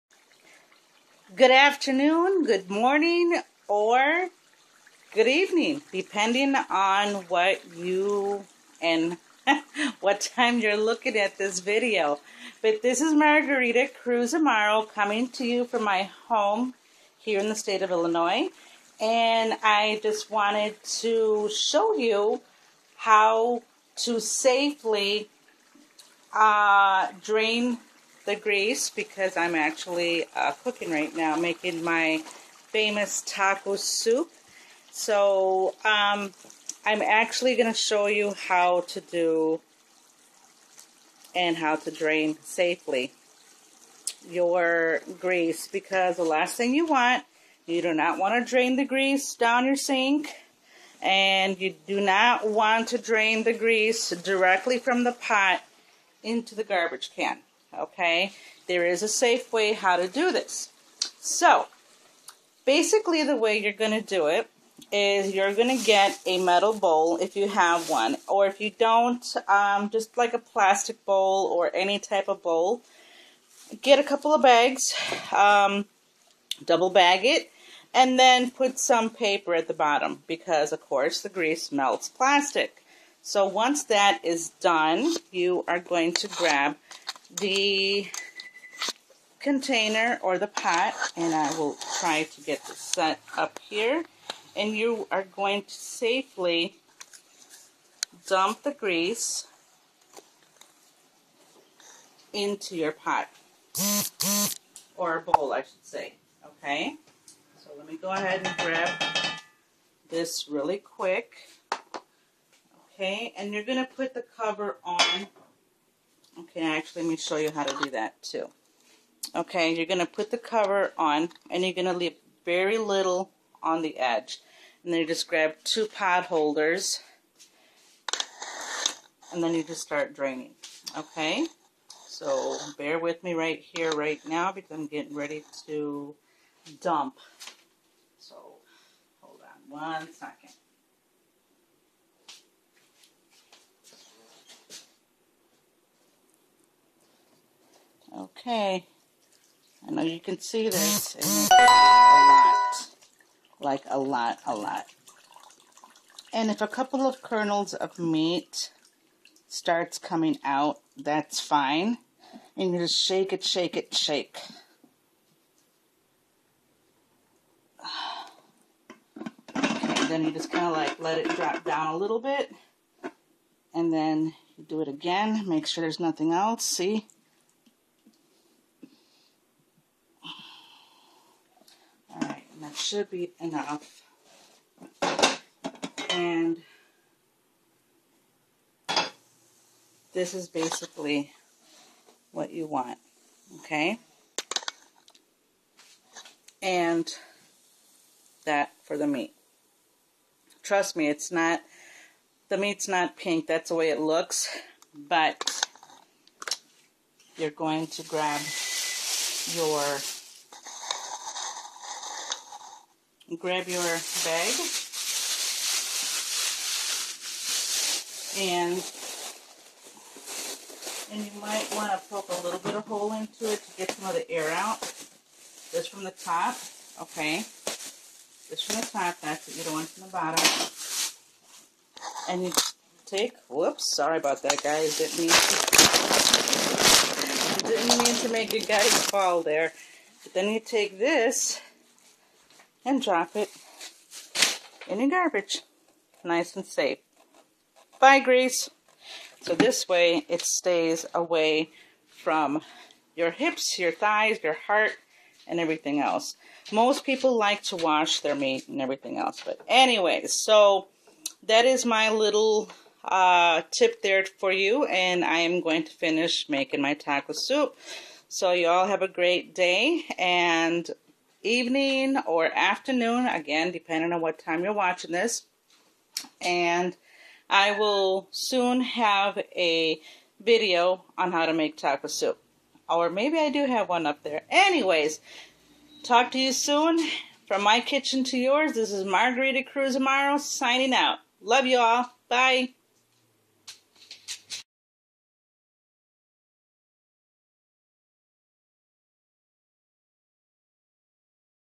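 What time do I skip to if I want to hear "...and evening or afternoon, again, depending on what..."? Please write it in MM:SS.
04:30.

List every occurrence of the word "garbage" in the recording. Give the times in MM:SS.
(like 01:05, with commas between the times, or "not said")
00:56, 04:05.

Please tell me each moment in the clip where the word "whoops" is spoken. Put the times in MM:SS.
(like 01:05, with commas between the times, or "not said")
03:53.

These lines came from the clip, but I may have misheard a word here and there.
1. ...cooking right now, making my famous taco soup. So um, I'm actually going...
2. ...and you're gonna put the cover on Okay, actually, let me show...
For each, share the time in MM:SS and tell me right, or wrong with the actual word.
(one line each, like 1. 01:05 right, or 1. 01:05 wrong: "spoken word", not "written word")
1. 00:30 right
2. 01:53 right.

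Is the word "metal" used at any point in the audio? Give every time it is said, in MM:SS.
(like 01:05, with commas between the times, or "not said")
01:06.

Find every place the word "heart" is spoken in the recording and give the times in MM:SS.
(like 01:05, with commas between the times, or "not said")
04:14.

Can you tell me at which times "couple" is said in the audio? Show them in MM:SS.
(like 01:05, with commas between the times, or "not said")
01:14, 02:36.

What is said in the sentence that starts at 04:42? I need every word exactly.
Or maybe I do have one up there.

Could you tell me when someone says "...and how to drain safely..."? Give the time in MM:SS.
00:41.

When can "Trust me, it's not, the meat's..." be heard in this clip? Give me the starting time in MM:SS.
03:20.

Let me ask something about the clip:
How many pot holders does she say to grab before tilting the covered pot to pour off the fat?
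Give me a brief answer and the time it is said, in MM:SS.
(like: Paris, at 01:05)
2, at 02:05.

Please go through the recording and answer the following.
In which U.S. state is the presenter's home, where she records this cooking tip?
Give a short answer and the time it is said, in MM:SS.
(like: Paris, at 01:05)
Illinois, at 00:17.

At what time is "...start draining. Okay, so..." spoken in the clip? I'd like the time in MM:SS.
02:09.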